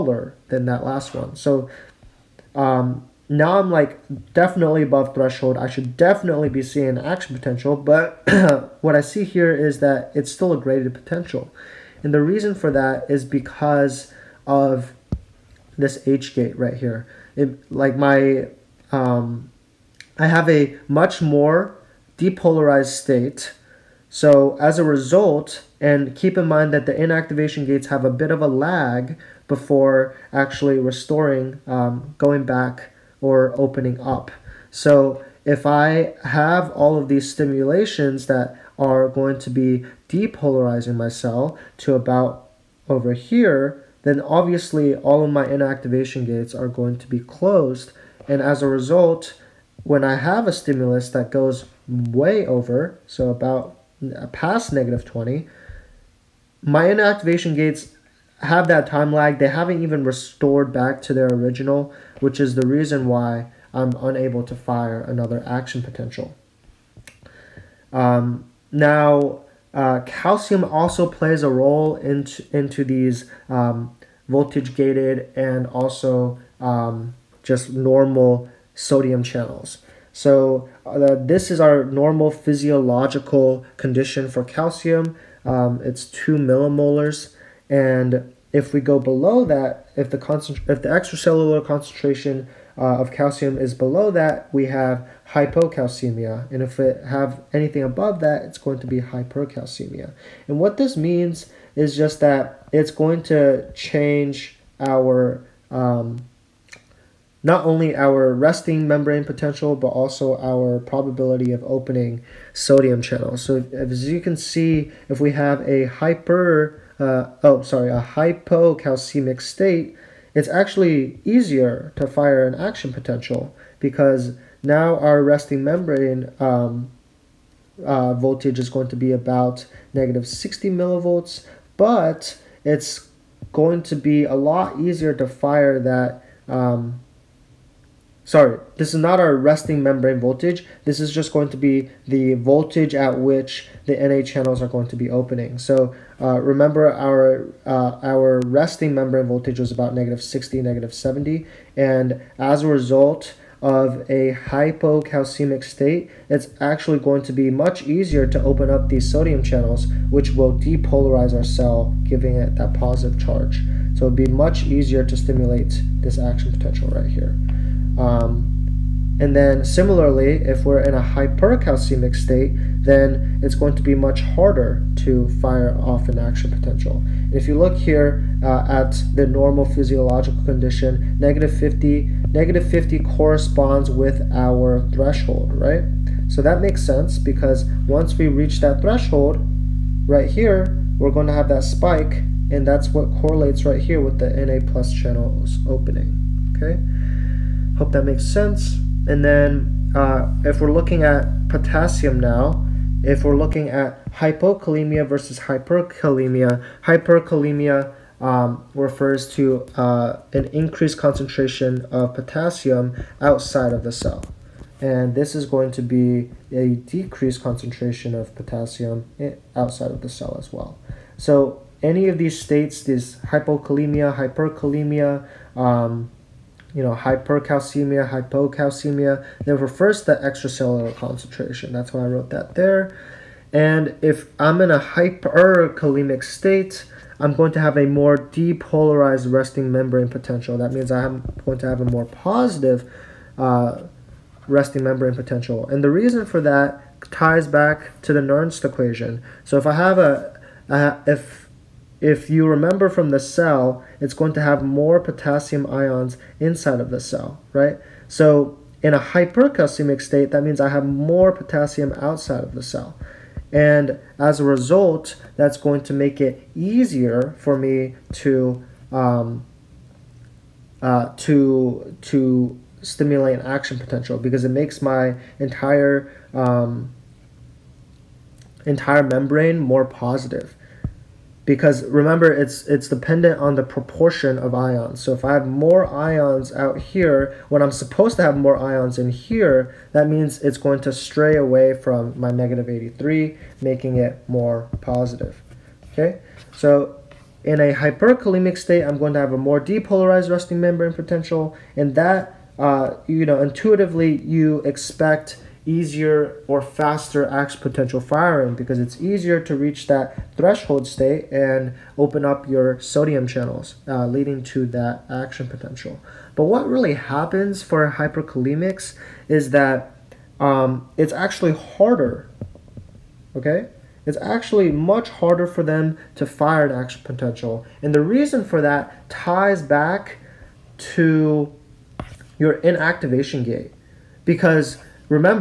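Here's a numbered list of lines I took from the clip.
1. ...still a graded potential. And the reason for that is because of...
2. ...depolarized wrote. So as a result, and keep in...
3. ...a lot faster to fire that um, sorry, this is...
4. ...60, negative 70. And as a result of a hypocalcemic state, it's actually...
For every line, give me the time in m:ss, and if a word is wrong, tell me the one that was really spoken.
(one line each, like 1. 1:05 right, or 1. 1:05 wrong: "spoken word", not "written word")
1. 0:10 right
2. 0:22 wrong: "state", not "wrote"
3. 2:14 wrong: "easier", not "faster"
4. 2:30 right.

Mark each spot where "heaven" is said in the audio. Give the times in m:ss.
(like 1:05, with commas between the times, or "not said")
not said.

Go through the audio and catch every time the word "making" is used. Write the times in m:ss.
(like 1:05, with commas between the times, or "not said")
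4:53.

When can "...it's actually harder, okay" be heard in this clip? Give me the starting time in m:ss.
5:20.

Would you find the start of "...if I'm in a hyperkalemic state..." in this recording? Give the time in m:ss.
3:54.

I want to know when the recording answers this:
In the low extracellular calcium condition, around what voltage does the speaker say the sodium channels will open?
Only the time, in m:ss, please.
2:09.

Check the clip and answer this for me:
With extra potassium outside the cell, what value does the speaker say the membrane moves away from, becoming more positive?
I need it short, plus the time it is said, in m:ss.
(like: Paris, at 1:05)
-83, at 4:52.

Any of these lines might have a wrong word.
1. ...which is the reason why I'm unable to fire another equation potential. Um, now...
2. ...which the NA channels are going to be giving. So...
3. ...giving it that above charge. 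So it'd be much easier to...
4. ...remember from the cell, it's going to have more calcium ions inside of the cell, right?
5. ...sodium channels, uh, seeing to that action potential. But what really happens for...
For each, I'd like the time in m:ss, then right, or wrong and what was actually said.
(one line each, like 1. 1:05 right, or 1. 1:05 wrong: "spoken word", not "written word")
1. 1:02 wrong: "action", not "equation"
2. 2:23 wrong: "opening", not "giving"
3. 2:42 wrong: "positive", not "above"
4. 4:12 wrong: "potassium", not "calcium"
5. 5:12 wrong: "leading", not "seeing".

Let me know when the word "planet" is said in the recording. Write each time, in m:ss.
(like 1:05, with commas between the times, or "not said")
not said.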